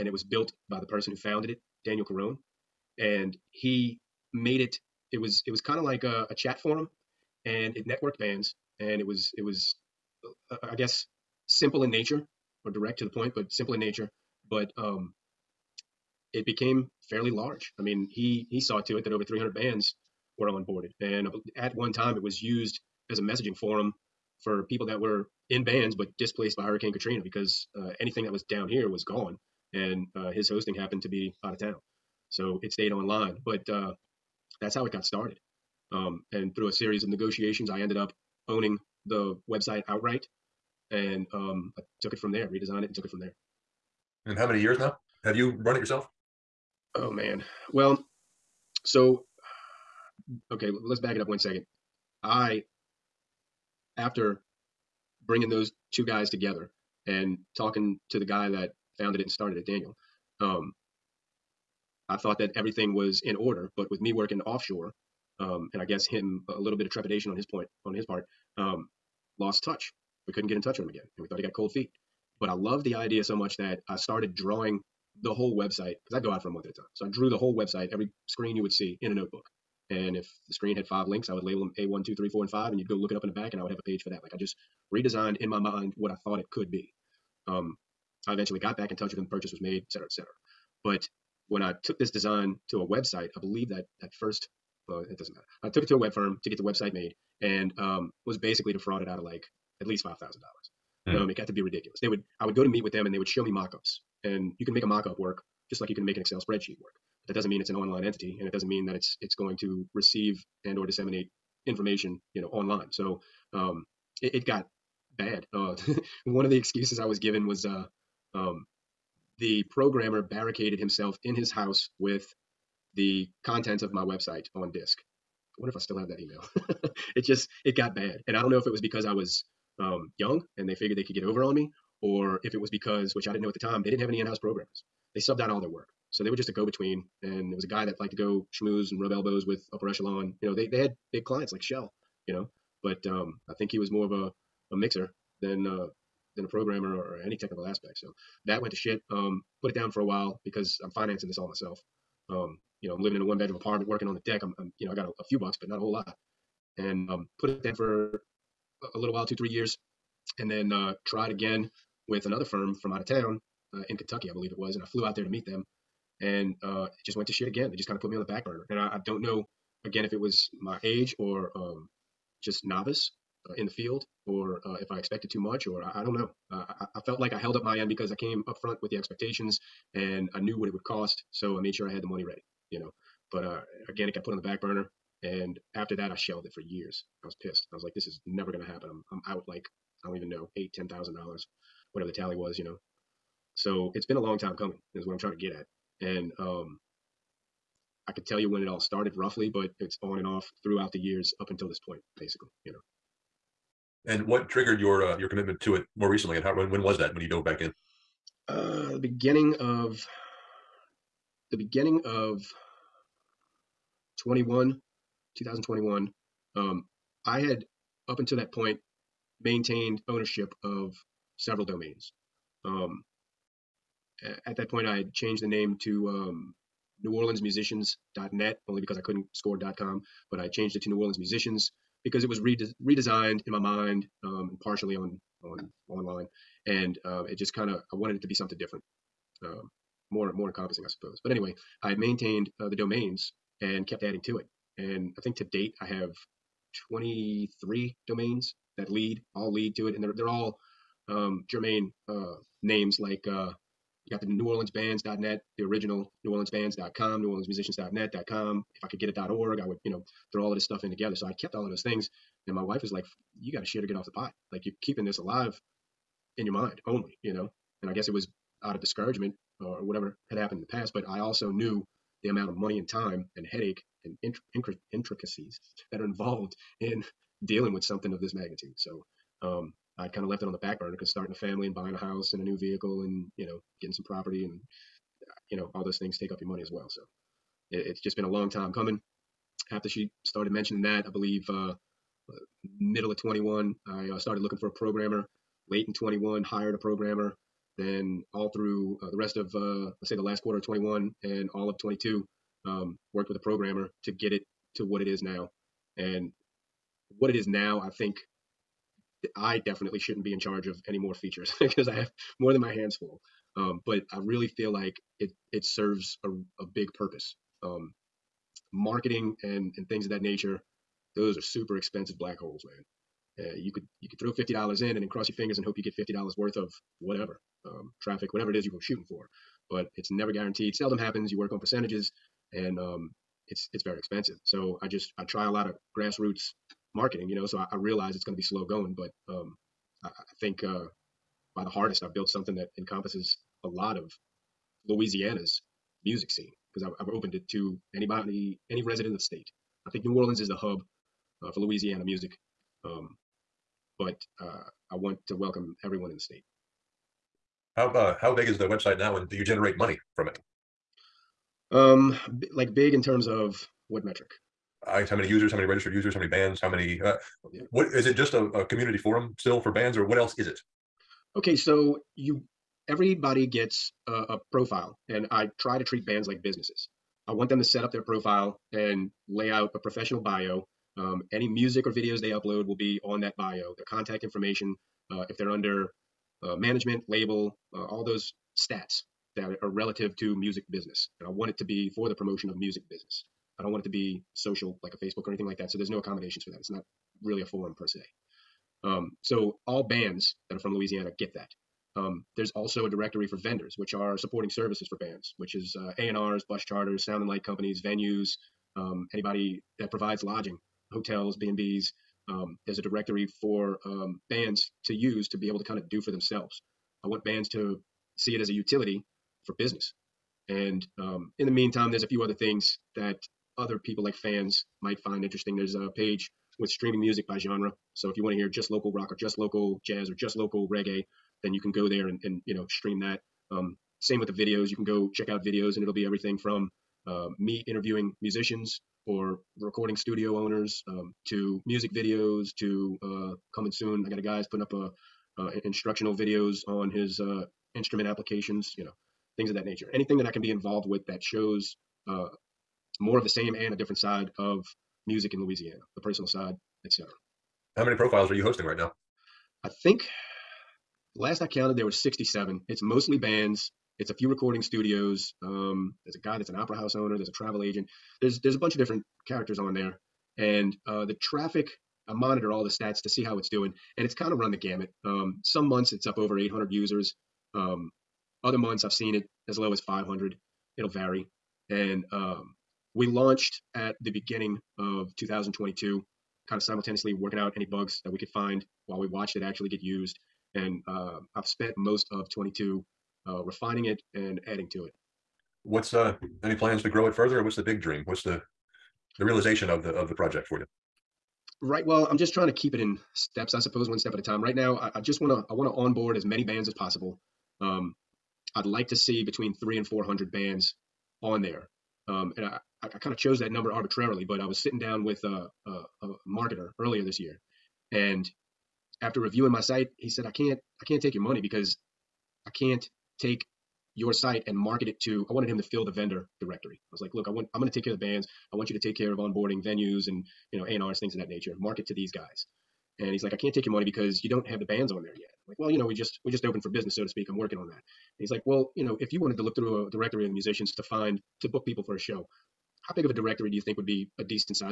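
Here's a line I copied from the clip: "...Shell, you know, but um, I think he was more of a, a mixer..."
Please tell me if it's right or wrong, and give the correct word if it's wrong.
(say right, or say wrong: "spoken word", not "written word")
right.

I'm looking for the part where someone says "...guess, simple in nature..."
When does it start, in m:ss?
0:10.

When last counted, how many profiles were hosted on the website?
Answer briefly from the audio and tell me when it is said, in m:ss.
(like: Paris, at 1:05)
67, at 7:41.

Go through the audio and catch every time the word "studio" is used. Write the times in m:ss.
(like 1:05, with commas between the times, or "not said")
7:19, 7:44.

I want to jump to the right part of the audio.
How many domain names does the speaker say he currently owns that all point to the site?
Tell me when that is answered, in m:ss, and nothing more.
4:06.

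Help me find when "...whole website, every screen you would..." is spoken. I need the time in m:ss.
1:17.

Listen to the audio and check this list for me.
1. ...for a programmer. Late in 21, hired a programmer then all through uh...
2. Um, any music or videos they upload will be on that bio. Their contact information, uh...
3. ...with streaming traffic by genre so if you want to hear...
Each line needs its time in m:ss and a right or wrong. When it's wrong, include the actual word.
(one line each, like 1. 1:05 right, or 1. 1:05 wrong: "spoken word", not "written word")
1. 4:54 right
2. 6:20 right
3. 7:06 wrong: "music", not "traffic".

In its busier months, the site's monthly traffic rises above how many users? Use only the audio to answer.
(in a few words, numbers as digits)
800.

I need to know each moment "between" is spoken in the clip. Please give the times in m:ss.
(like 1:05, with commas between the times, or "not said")
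2:16, 8:29.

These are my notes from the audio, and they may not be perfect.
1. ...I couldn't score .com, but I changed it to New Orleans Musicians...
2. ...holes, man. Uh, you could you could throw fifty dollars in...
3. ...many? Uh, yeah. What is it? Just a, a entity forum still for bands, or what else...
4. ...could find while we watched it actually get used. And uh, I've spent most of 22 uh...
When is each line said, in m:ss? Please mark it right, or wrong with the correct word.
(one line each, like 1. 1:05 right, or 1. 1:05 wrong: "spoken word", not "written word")
1. 3:48 right
2. 5:22 right
3. 6:06 wrong: "community", not "entity"
4. 8:08 right.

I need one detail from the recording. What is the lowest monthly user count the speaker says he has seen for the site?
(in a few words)
500.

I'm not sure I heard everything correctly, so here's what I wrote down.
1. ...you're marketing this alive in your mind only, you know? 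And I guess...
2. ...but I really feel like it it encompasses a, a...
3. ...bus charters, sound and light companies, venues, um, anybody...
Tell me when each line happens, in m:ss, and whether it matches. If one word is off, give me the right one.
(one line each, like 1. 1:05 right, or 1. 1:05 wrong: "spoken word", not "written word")
1. 4:24 wrong: "keeping", not "marketing"
2. 5:13 wrong: "serves", not "encompasses"
3. 6:46 right.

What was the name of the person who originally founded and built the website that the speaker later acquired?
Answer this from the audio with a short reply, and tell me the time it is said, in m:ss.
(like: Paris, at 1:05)
Daniel Carone, at 0:01.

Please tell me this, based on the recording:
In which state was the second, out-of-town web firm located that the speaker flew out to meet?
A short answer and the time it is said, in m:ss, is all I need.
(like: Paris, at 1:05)
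Kentucky, at 2:43.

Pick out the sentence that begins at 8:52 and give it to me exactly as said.
And he's like, I can't take your money because you don't have the bands on there yet.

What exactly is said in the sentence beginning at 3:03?
But uh, again, it got put on the back burner and after that, I shelved it for years.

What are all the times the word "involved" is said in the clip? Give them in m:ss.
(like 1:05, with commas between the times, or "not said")
4:36, 7:30.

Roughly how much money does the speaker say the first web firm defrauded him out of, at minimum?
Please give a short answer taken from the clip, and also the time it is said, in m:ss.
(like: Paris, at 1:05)
$5,000, at 1:40.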